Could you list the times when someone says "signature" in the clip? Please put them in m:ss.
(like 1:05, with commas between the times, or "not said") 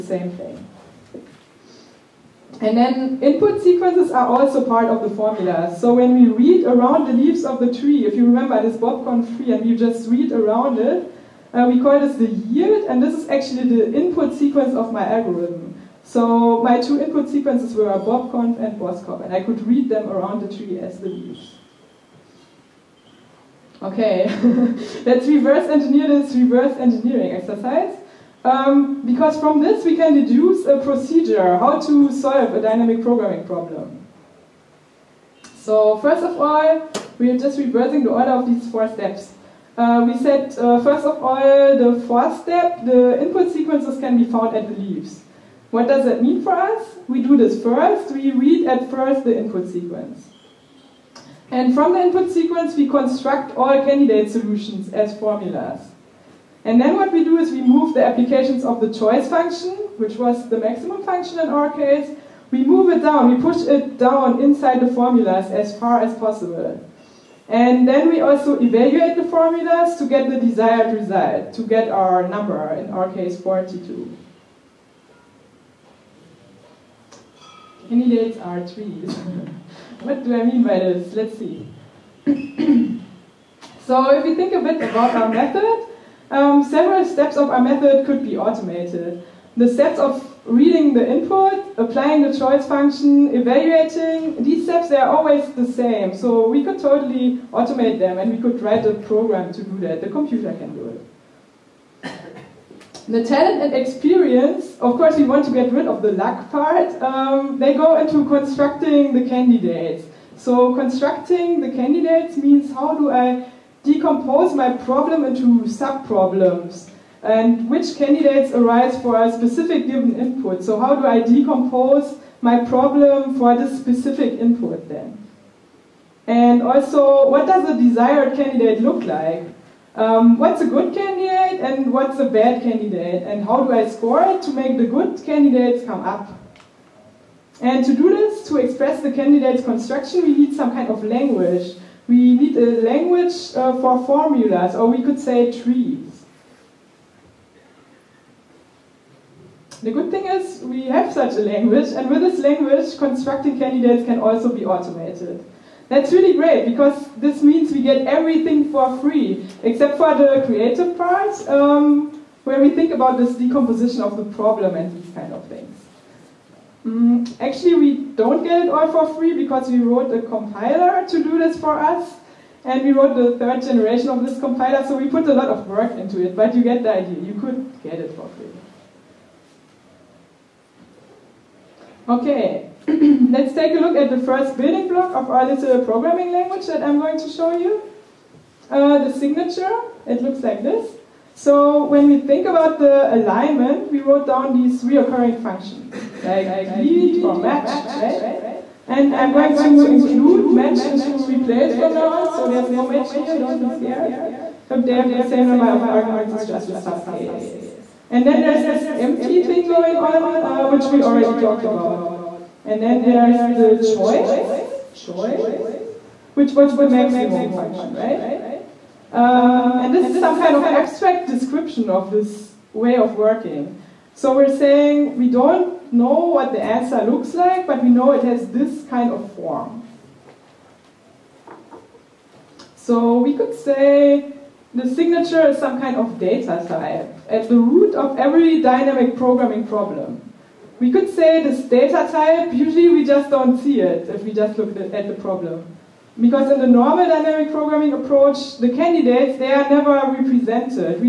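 3:09, 3:54.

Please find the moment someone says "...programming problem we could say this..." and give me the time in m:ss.
3:59.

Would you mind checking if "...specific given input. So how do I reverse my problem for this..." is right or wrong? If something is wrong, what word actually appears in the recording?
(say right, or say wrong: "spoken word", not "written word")
wrong: "decompose", not "reverse".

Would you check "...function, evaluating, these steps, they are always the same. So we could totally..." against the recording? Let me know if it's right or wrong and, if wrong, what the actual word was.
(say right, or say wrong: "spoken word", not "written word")
right.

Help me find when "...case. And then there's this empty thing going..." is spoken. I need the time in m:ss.
3:27.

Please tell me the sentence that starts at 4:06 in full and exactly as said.
Because in the normal dynamic programming approach, the candidates, they are never represented.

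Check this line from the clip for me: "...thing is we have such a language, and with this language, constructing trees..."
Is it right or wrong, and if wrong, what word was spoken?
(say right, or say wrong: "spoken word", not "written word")
wrong: "candidates", not "trees".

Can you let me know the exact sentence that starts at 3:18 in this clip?
And I'm going to include match into replace from now on, so there's no match here, don't be scared.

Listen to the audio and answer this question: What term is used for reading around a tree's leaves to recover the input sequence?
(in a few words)
the yield.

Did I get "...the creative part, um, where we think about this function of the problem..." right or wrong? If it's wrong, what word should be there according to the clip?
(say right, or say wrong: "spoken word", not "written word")
wrong: "decomposition", not "function".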